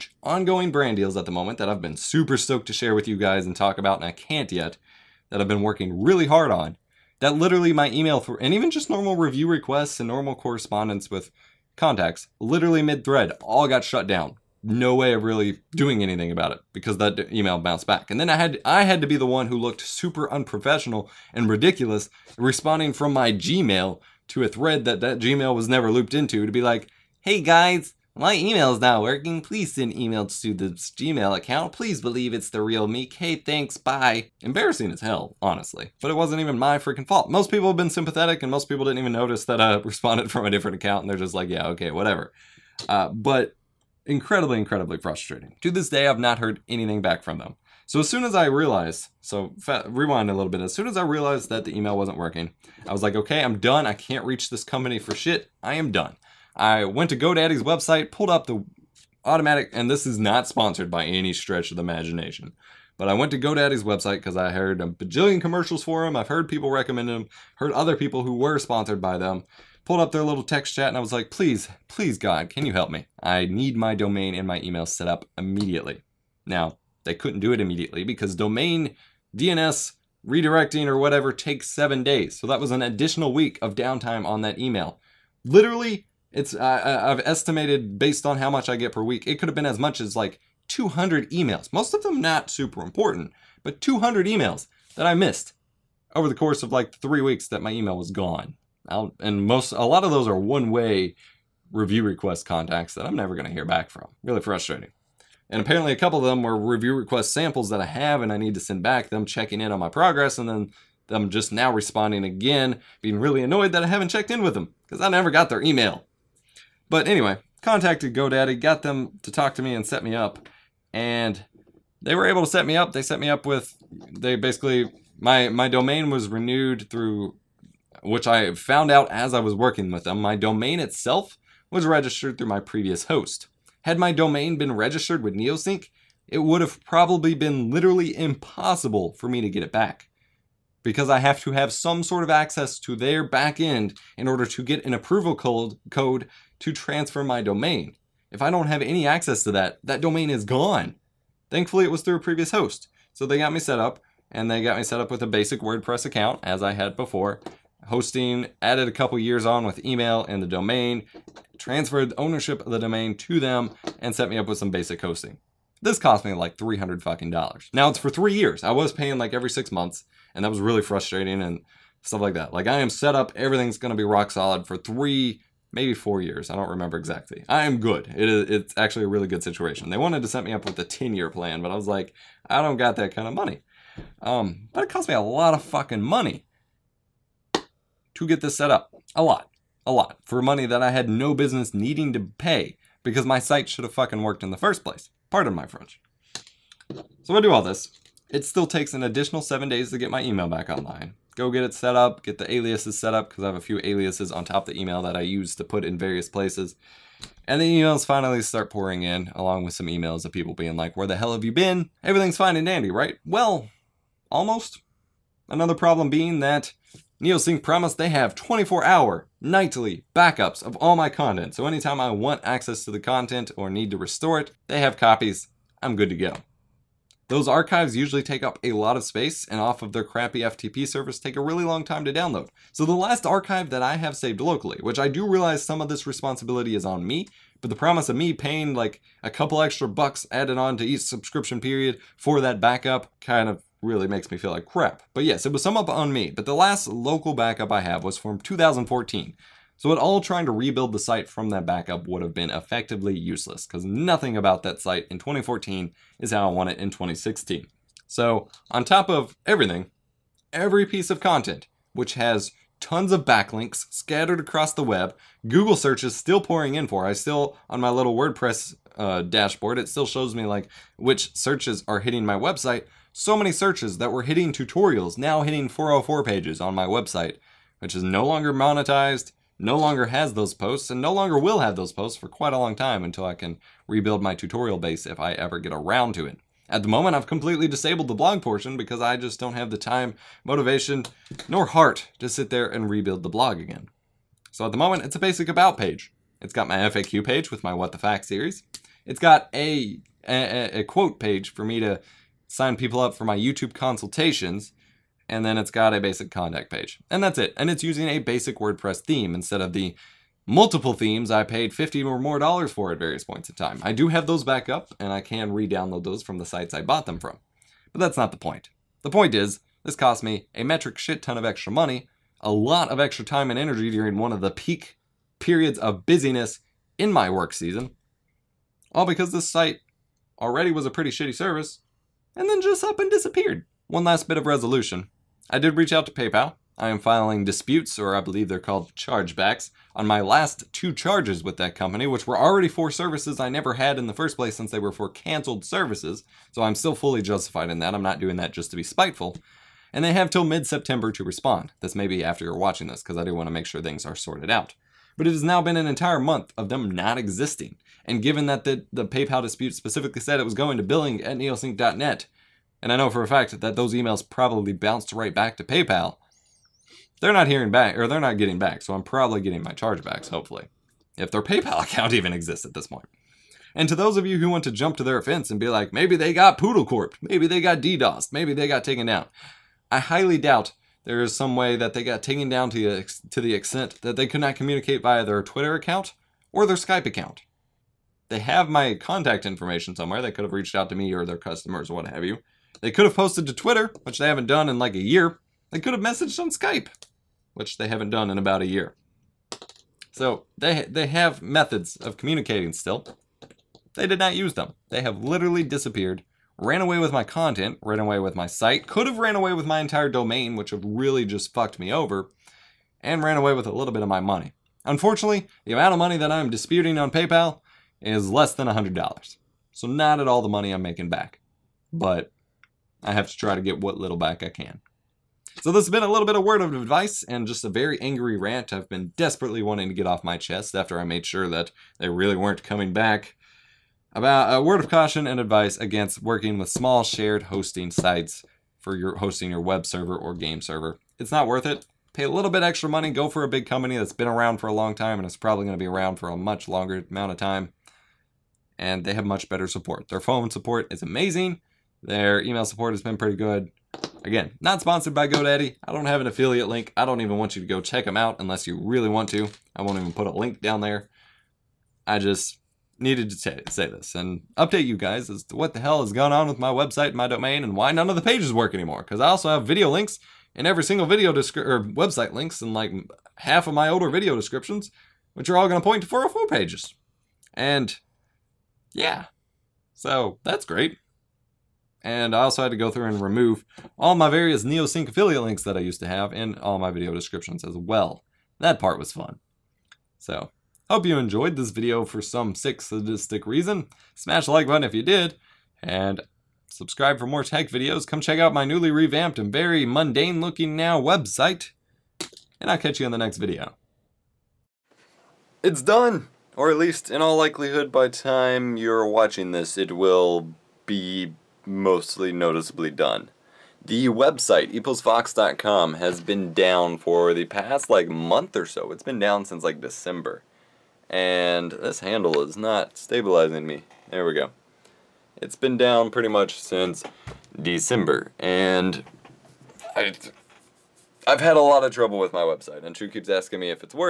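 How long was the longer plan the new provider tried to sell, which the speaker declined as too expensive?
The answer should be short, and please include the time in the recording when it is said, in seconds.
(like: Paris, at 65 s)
10 years, at 180 s.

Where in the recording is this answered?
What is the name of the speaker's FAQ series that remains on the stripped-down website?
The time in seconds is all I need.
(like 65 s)
297 s.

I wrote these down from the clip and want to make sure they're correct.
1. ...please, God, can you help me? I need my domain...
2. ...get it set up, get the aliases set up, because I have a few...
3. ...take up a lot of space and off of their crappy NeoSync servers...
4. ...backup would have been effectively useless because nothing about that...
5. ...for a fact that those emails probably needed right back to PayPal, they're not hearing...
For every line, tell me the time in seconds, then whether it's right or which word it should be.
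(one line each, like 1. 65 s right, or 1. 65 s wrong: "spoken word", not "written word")
1. 71 s right
2. 201 s right
3. 228 s wrong: "FTP", not "NeoSync"
4. 251 s right
5. 363 s wrong: "bounced", not "needed".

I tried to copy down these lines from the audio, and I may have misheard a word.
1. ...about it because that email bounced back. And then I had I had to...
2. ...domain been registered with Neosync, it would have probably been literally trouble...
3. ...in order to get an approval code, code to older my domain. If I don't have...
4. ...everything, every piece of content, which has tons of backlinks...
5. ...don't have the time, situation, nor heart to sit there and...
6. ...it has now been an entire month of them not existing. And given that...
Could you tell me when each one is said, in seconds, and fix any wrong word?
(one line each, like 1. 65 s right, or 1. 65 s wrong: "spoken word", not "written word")
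1. 16 s right
2. 134 s wrong: "impossible", not "trouble"
3. 144 s wrong: "transfer", not "older"
4. 259 s right
5. 289 s wrong: "motivation", not "situation"
6. 355 s right.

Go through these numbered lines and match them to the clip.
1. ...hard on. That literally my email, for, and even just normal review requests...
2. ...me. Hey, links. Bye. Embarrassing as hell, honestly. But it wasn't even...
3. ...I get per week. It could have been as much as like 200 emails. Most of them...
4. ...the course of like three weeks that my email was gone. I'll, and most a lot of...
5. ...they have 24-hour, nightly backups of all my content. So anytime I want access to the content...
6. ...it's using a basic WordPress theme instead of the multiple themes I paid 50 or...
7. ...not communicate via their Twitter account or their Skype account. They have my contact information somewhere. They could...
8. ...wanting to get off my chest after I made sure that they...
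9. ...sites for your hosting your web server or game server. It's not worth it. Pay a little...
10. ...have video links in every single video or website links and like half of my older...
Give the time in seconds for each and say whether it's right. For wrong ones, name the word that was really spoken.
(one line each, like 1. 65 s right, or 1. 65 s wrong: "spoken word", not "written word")
1. 6 s right
2. 32 s wrong: "thanks", not "links"
3. 88 s right
4. 96 s right
5. 217 s right
6. 307 s right
7. 384 s right
8. 429 s right
9. 437 s right
10. 469 s right.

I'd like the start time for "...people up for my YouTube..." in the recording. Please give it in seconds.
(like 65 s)
302 s.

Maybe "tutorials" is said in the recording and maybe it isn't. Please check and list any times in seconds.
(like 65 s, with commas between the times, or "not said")
274 s, 284 s.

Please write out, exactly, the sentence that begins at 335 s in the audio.
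I did reach out to PayPal.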